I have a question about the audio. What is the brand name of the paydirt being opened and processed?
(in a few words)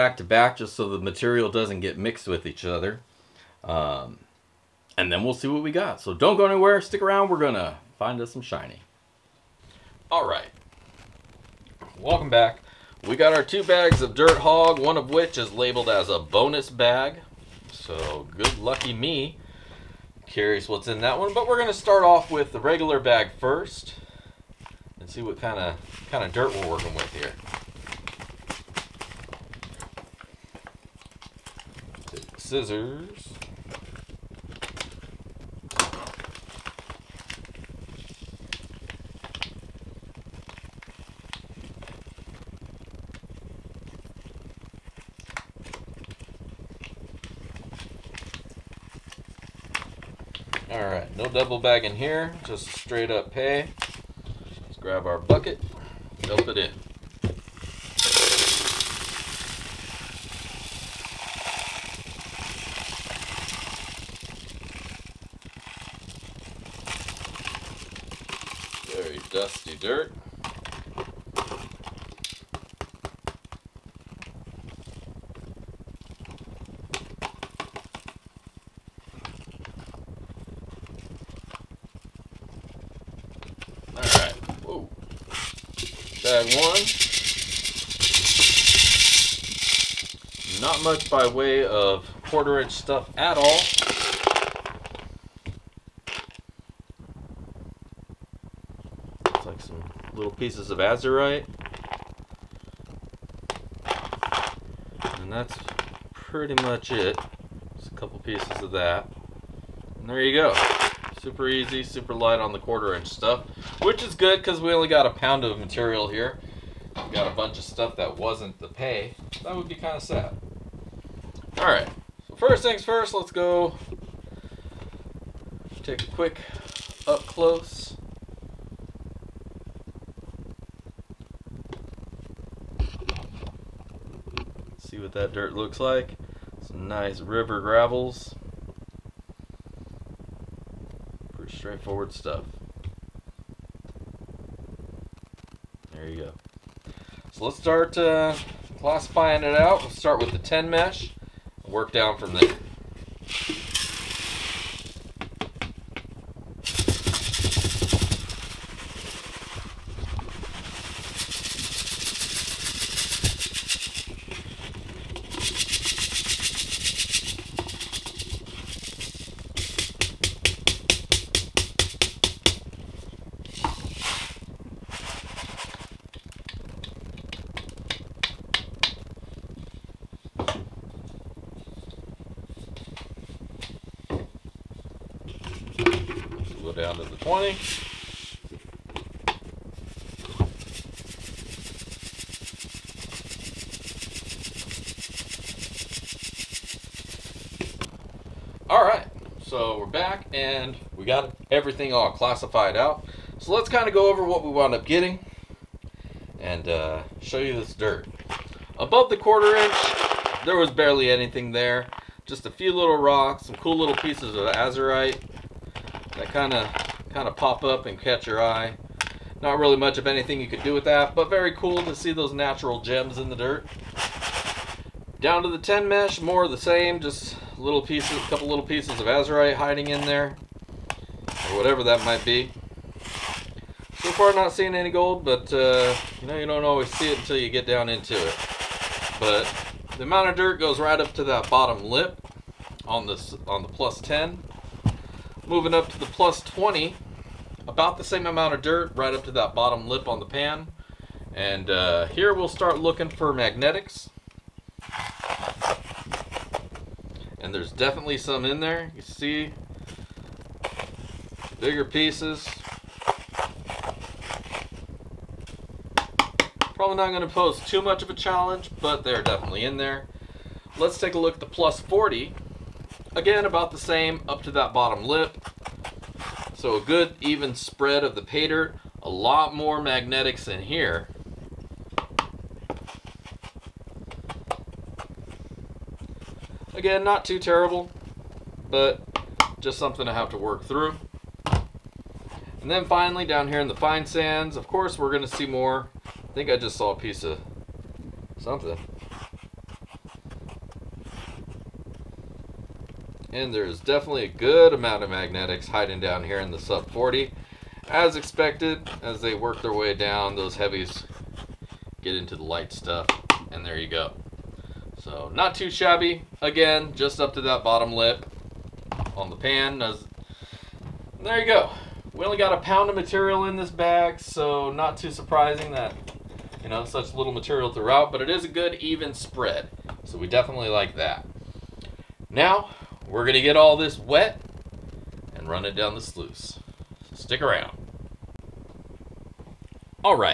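DirtHogg.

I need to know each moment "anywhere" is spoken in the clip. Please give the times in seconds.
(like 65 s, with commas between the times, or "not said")
6 s.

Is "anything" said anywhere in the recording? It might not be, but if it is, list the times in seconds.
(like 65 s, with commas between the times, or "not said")
211 s, 220 s.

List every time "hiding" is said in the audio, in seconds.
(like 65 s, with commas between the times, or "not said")
229 s, 305 s.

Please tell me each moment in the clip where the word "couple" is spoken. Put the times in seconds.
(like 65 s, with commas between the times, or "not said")
107 s, 228 s.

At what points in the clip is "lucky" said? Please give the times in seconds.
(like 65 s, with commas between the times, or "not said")
18 s.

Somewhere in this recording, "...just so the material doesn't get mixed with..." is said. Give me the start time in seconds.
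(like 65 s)
0 s.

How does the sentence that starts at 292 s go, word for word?
And then finally, down here in the fine sands, of course, we're going to see more.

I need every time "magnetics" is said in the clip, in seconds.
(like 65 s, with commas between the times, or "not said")
253 s, 279 s, 305 s.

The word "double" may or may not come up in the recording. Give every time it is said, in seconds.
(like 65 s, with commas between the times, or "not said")
51 s.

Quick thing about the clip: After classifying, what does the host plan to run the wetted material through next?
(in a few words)
the sluice.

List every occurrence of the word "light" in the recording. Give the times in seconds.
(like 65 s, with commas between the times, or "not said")
112 s, 312 s.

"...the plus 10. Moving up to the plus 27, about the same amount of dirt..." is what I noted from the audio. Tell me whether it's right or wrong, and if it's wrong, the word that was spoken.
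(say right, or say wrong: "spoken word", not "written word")
wrong: "20", not "27".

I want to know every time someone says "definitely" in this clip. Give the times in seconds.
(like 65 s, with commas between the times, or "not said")
257 s, 269 s, 303 s, 330 s.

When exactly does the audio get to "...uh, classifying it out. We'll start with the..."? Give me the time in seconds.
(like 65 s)
147 s.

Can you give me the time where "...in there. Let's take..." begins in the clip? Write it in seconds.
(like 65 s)
269 s.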